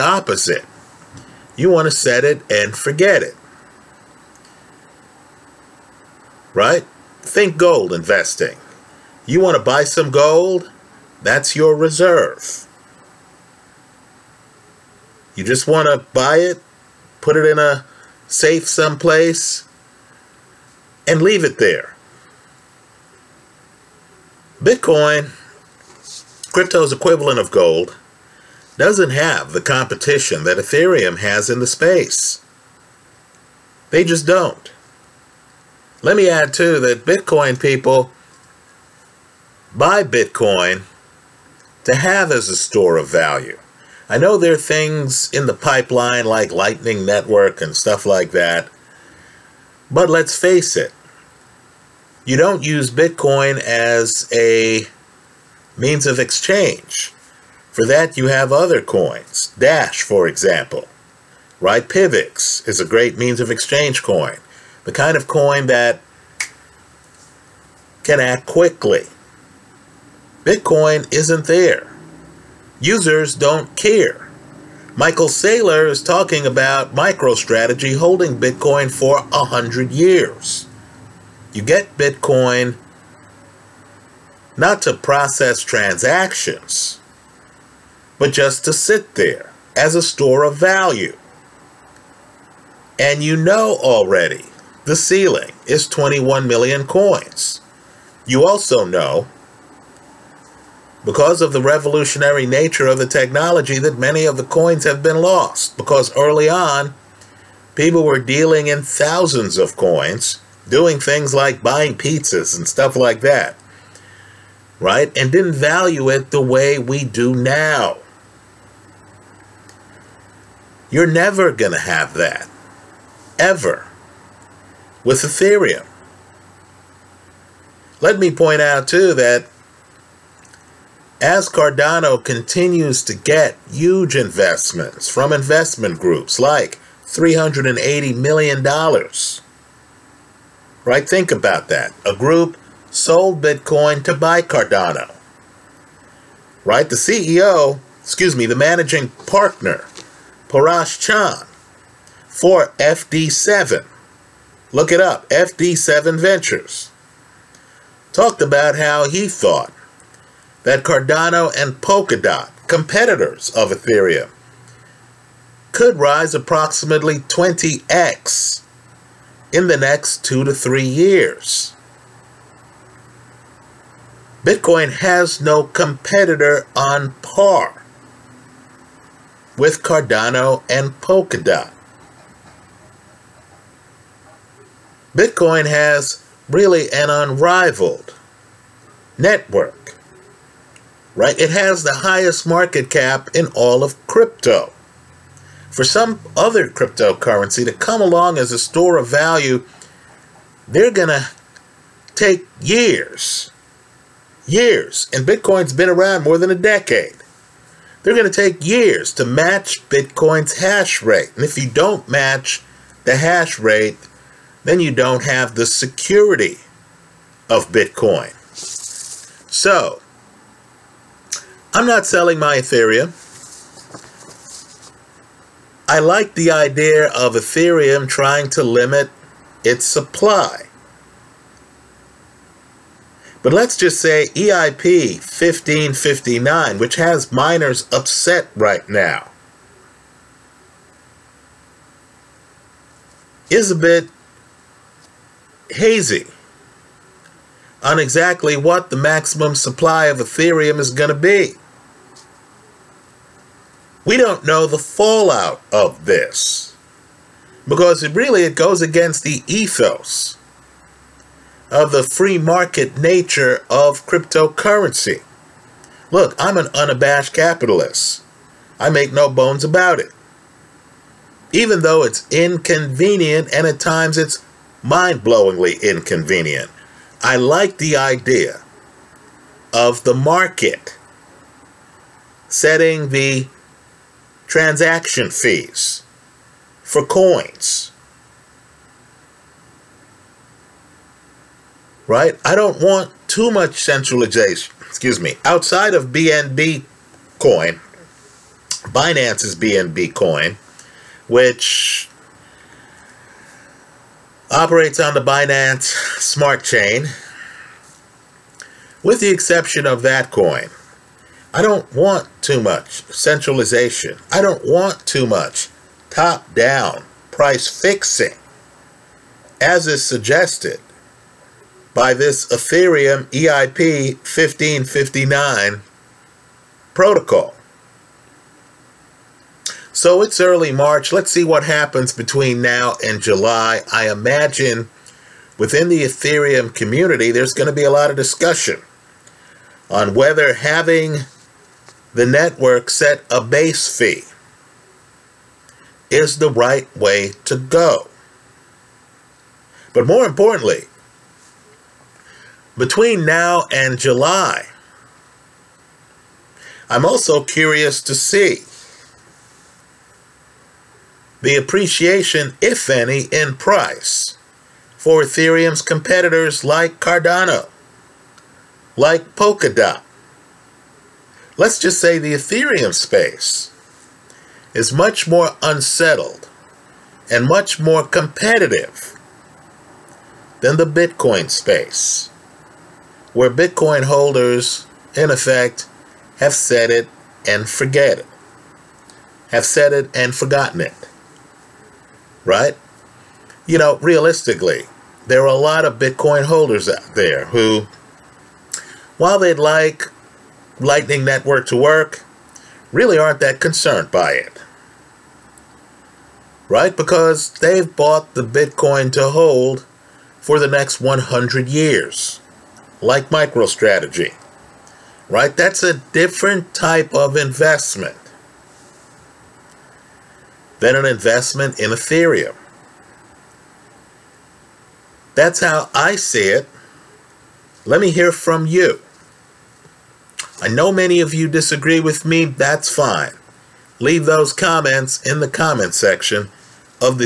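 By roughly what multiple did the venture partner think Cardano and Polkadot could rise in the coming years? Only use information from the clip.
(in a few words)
20x.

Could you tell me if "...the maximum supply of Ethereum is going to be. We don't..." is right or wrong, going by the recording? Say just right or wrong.
right.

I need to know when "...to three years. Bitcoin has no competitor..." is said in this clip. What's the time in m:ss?
2:50.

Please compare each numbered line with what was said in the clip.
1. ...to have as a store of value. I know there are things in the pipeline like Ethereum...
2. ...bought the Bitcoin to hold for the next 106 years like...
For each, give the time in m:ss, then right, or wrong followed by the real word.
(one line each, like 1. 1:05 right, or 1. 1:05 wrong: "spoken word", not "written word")
1. 0:41 wrong: "Lightning", not "Ethereum"
2. 6:47 wrong: "100", not "106".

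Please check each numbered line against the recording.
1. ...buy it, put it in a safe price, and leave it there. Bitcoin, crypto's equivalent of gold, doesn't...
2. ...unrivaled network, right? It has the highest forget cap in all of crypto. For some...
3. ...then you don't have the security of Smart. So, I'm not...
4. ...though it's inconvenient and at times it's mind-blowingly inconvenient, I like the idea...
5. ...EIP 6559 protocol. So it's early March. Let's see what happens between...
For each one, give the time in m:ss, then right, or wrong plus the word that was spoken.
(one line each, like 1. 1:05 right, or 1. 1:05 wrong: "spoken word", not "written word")
1. 0:16 wrong: "someplace", not "price"
2. 3:07 wrong: "market", not "forget"
3. 3:34 wrong: "Bitcoin", not "Smart"
4. 4:31 right
5. 5:23 wrong: "1559", not "6559".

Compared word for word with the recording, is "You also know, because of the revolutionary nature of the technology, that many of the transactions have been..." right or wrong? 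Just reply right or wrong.
wrong.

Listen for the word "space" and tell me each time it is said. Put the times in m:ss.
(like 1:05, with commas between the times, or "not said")
0:31, 6:12, 6:21.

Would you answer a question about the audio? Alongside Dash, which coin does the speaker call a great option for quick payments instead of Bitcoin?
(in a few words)
Pivx.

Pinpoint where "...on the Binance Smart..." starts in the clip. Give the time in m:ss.
5:04.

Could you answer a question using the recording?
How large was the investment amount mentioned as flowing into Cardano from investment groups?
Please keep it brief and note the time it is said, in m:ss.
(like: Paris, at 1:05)
$380 million, at 2:17.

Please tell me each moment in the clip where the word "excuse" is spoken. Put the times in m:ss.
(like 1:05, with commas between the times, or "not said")
2:28, 4:54.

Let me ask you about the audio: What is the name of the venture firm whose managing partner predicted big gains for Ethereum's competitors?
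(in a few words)
FD7 Ventures.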